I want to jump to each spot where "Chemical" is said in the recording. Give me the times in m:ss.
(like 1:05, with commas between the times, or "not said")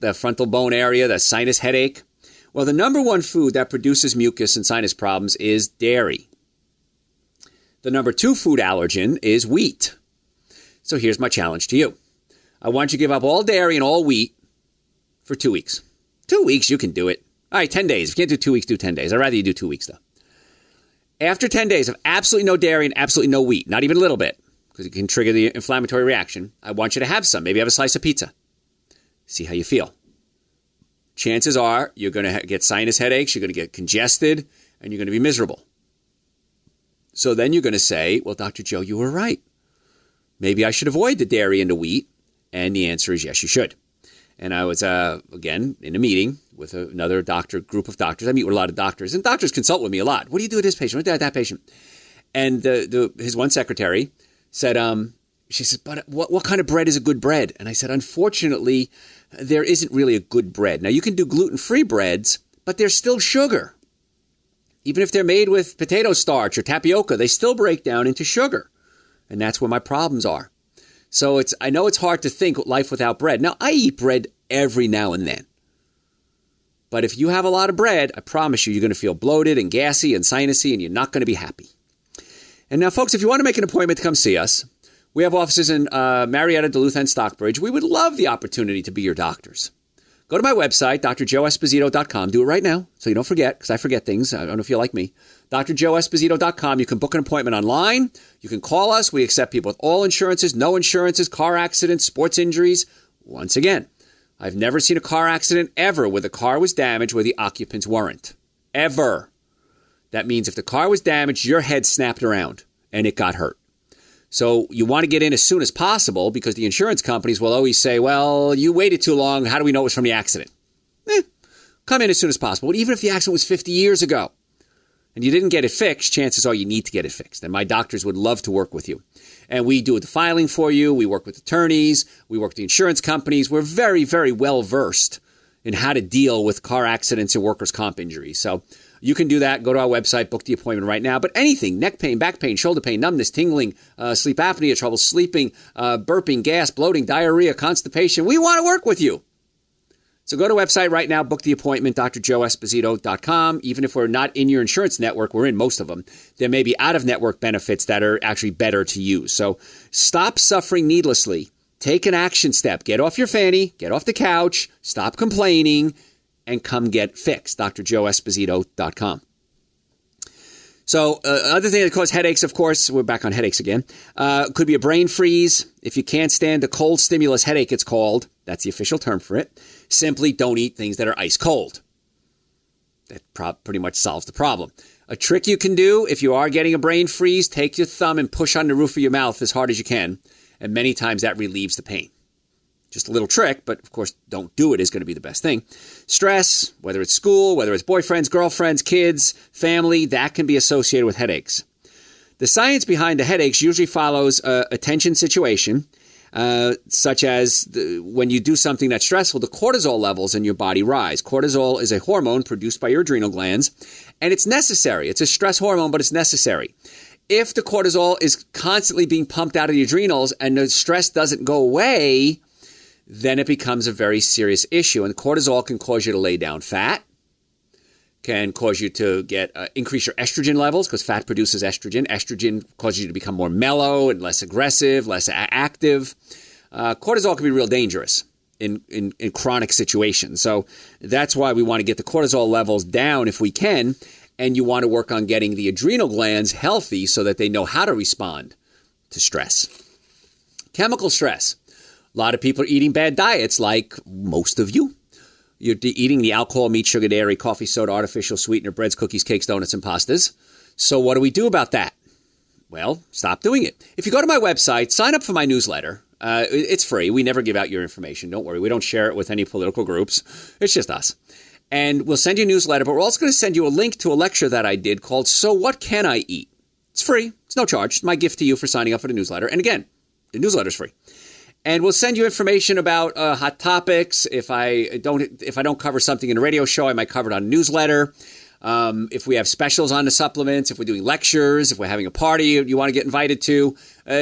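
4:10.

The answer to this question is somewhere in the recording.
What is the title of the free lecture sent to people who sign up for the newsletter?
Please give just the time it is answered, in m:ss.
4:35.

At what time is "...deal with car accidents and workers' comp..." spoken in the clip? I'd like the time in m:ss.
2:16.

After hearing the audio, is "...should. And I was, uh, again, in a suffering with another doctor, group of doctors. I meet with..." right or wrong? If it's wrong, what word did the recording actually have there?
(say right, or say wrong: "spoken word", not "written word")
wrong: "meeting", not "suffering".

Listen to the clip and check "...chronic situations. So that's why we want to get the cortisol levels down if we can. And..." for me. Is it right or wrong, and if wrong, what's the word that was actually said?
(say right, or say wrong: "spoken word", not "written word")
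right.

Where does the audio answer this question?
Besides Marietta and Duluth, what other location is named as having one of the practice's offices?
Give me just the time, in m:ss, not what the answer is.
1:27.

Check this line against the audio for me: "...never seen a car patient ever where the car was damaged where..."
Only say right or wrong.
wrong.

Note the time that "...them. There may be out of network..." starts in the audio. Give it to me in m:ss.
2:35.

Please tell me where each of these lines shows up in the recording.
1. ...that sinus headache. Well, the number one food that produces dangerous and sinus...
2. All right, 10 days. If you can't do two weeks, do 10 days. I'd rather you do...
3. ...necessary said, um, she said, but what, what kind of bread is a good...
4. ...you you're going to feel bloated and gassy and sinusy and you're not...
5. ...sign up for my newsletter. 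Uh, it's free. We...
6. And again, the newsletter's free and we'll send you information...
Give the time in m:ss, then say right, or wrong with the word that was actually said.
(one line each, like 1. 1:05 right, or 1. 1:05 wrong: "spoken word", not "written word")
1. 0:01 wrong: "mucus", not "dangerous"
2. 0:17 right
3. 0:53 wrong: "secretary", not "necessary"
4. 1:18 right
5. 4:24 right
6. 4:39 right.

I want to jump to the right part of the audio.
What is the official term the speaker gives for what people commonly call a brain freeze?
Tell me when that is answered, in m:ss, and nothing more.
2:56.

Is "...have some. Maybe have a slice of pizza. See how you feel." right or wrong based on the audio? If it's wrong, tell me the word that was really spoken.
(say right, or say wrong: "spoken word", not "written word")
right.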